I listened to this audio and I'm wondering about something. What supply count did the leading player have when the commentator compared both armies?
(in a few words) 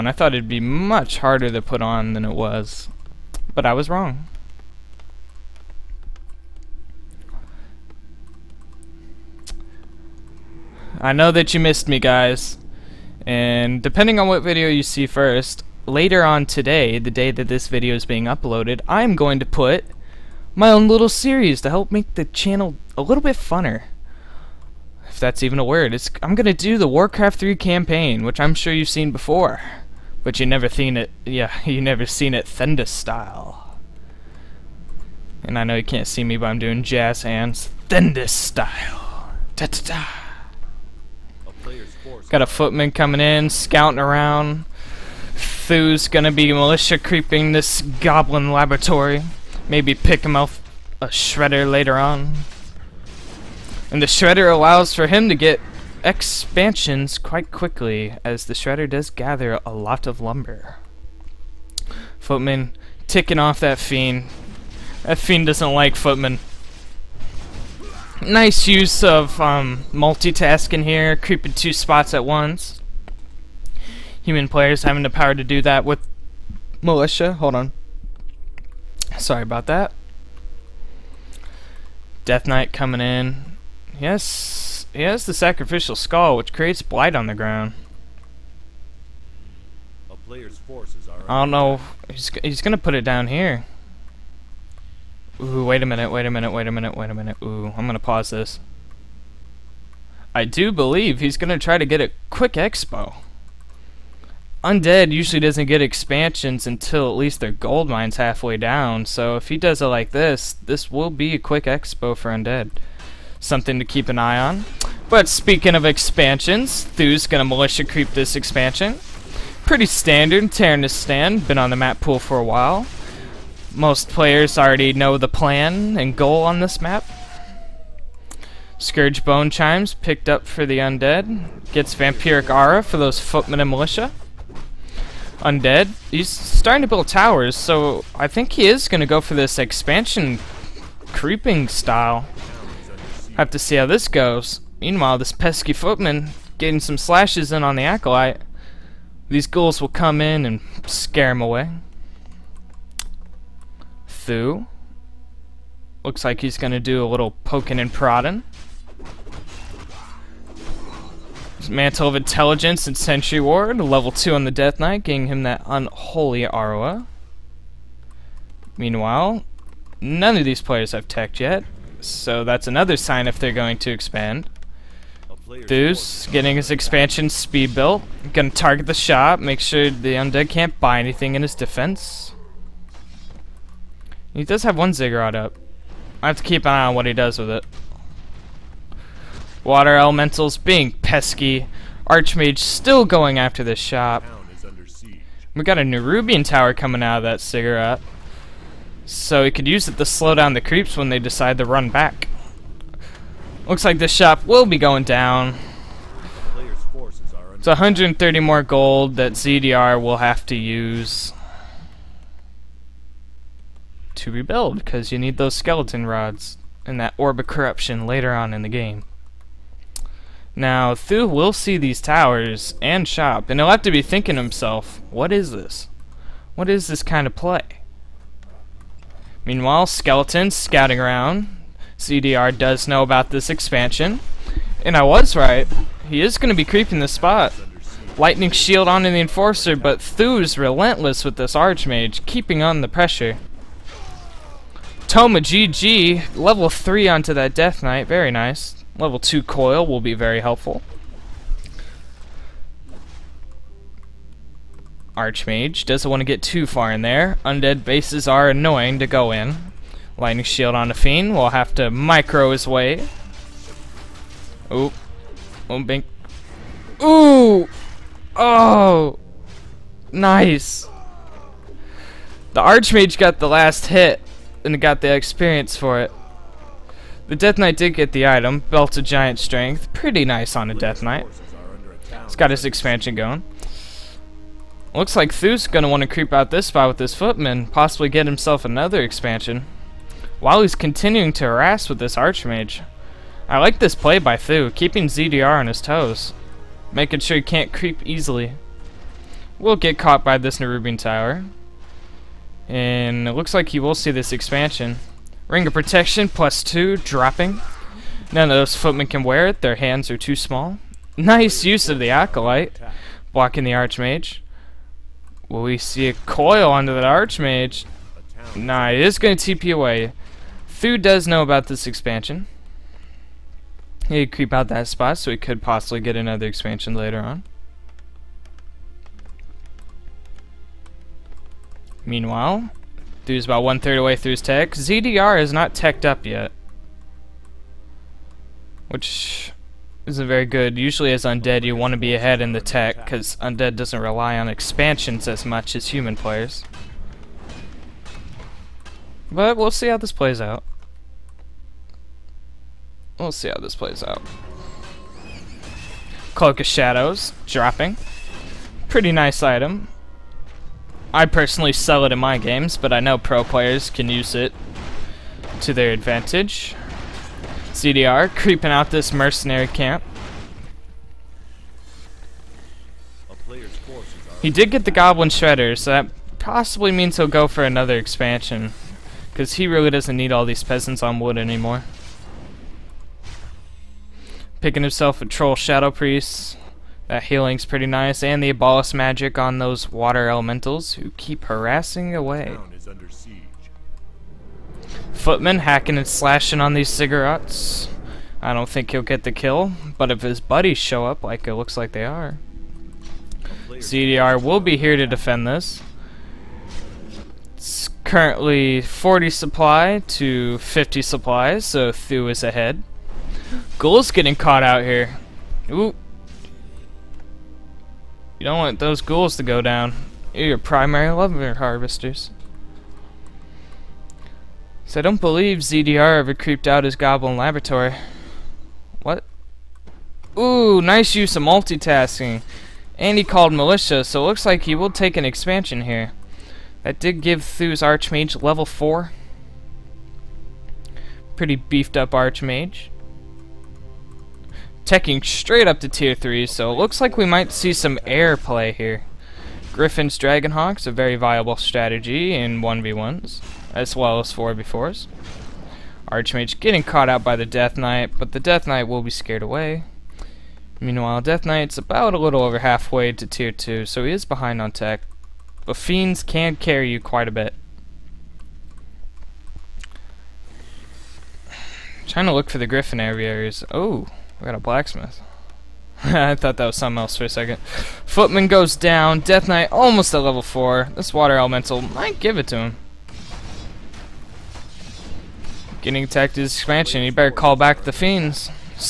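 50.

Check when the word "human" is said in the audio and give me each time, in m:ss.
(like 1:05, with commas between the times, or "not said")
1:14, 5:45.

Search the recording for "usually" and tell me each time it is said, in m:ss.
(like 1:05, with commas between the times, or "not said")
1:45, 5:40.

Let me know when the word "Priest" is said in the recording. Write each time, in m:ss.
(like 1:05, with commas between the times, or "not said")
6:25.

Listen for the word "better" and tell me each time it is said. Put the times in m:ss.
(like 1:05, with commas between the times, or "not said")
8:07.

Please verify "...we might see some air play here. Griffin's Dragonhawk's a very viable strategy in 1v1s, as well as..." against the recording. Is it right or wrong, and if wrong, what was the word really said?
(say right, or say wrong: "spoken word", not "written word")
right.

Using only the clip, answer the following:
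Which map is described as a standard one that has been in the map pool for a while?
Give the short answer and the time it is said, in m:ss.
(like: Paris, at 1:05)
Terenas Stand, at 2:00.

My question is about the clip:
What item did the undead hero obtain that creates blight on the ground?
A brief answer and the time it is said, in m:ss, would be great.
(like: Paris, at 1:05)
Sacrificial skull, at 1:25.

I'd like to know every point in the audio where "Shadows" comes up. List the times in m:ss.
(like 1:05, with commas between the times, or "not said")
5:56, 6:25.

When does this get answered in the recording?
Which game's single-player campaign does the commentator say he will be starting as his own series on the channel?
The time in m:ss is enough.
0:26.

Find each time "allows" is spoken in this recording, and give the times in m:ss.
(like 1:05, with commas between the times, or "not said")
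0:54.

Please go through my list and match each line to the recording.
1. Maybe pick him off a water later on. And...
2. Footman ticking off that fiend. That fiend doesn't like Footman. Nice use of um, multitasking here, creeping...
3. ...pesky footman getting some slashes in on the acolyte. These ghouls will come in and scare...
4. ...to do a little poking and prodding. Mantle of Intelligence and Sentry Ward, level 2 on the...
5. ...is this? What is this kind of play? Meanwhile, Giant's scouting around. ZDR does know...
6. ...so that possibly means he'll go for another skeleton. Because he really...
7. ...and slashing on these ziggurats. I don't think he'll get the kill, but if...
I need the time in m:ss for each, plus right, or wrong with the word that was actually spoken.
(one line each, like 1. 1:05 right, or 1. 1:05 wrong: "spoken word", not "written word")
1. 0:49 wrong: "shredder", not "water"
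2. 1:02 right
3. 2:25 right
4. 2:36 right
5. 3:45 wrong: "Skeleton", not "Giant"
6. 6:15 wrong: "expansion", not "skeleton"
7. 6:35 right.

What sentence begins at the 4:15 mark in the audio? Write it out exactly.
Archmage doesn't want to get too far in there.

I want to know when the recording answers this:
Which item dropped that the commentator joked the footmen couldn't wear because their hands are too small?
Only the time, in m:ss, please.
5:05.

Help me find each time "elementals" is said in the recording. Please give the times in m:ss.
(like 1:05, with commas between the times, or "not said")
3:09, 6:30, 8:01.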